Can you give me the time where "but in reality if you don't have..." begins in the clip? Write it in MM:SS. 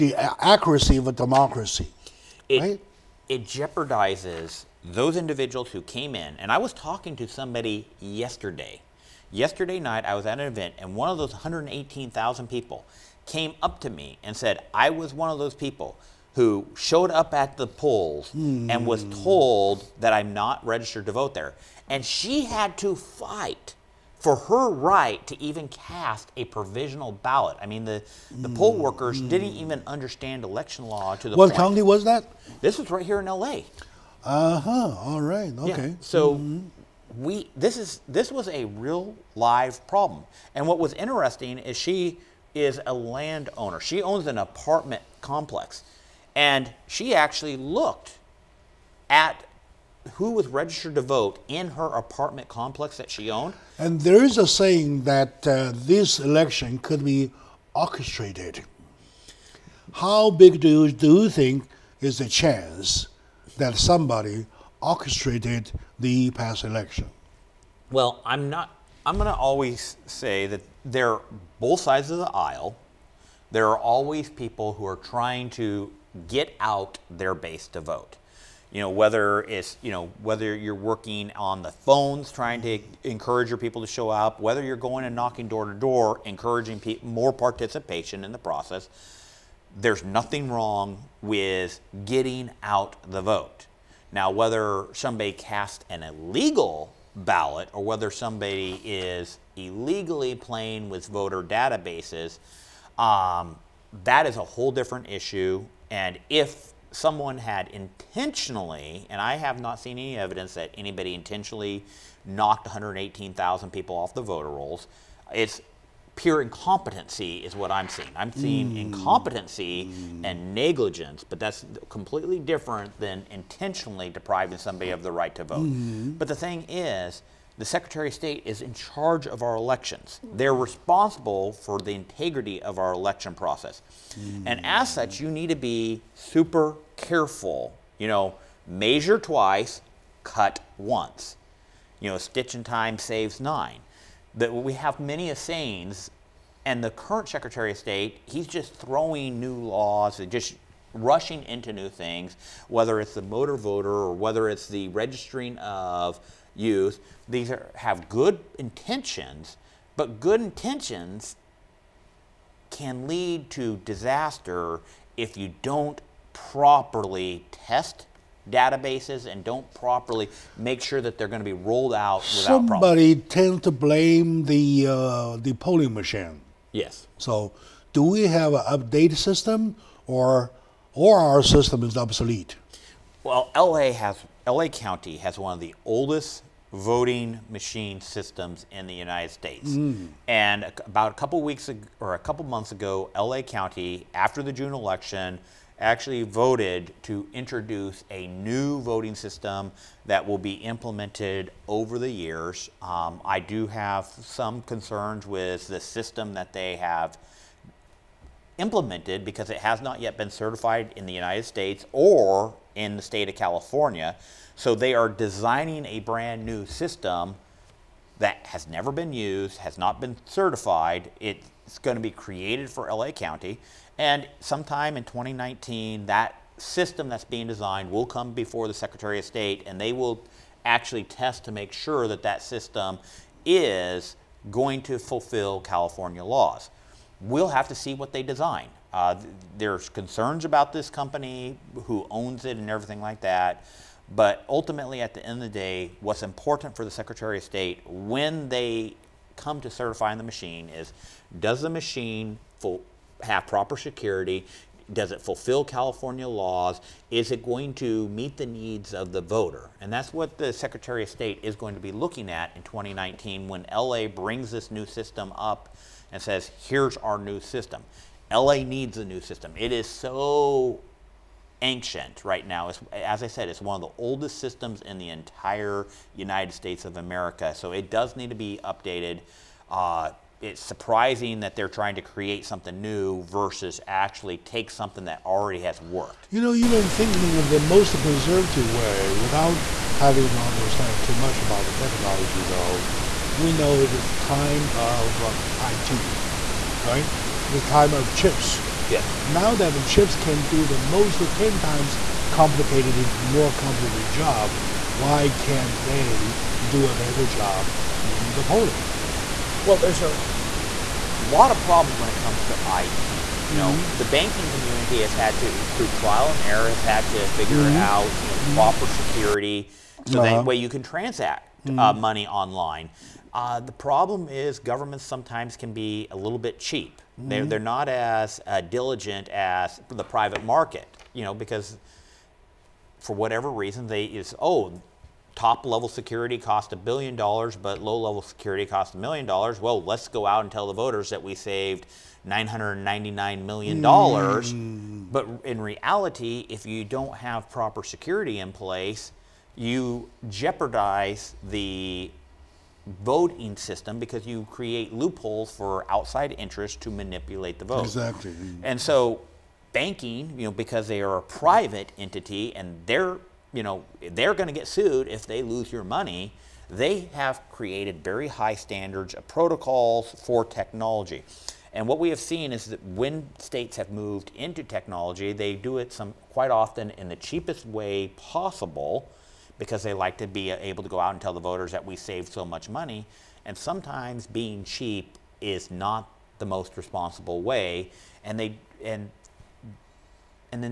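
05:45.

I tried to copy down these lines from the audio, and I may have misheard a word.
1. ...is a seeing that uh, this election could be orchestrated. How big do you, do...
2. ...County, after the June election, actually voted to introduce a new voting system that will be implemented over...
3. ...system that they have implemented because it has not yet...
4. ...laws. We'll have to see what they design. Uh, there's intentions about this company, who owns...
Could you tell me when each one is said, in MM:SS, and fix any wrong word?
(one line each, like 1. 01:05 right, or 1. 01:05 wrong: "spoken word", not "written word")
1. 00:54 wrong: "saying", not "seeing"
2. 03:13 right
3. 03:25 right
4. 03:56 wrong: "concerns", not "intentions".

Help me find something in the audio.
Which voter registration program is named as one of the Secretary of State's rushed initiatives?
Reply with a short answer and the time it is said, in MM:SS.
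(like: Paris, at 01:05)
motor voter, at 02:33.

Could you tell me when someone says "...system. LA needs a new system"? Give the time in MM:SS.
04:27.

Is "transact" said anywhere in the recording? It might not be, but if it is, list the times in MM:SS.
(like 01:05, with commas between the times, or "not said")
05:20.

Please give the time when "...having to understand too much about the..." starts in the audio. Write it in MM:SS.
04:49.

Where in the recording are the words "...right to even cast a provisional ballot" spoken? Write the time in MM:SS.
00:24.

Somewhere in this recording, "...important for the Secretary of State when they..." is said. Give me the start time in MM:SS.
04:06.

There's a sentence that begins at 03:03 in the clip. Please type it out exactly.
Well, LA has LA County has one of the oldest voting machine systems in the United States.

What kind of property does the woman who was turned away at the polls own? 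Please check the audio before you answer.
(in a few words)
an apartment complex.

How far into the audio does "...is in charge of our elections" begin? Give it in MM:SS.
02:08.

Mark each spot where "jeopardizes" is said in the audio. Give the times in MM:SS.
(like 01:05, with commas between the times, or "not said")
00:03, 05:50.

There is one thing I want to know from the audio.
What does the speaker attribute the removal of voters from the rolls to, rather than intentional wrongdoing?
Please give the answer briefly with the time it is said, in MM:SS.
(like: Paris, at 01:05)
pure incompetency, at 01:56.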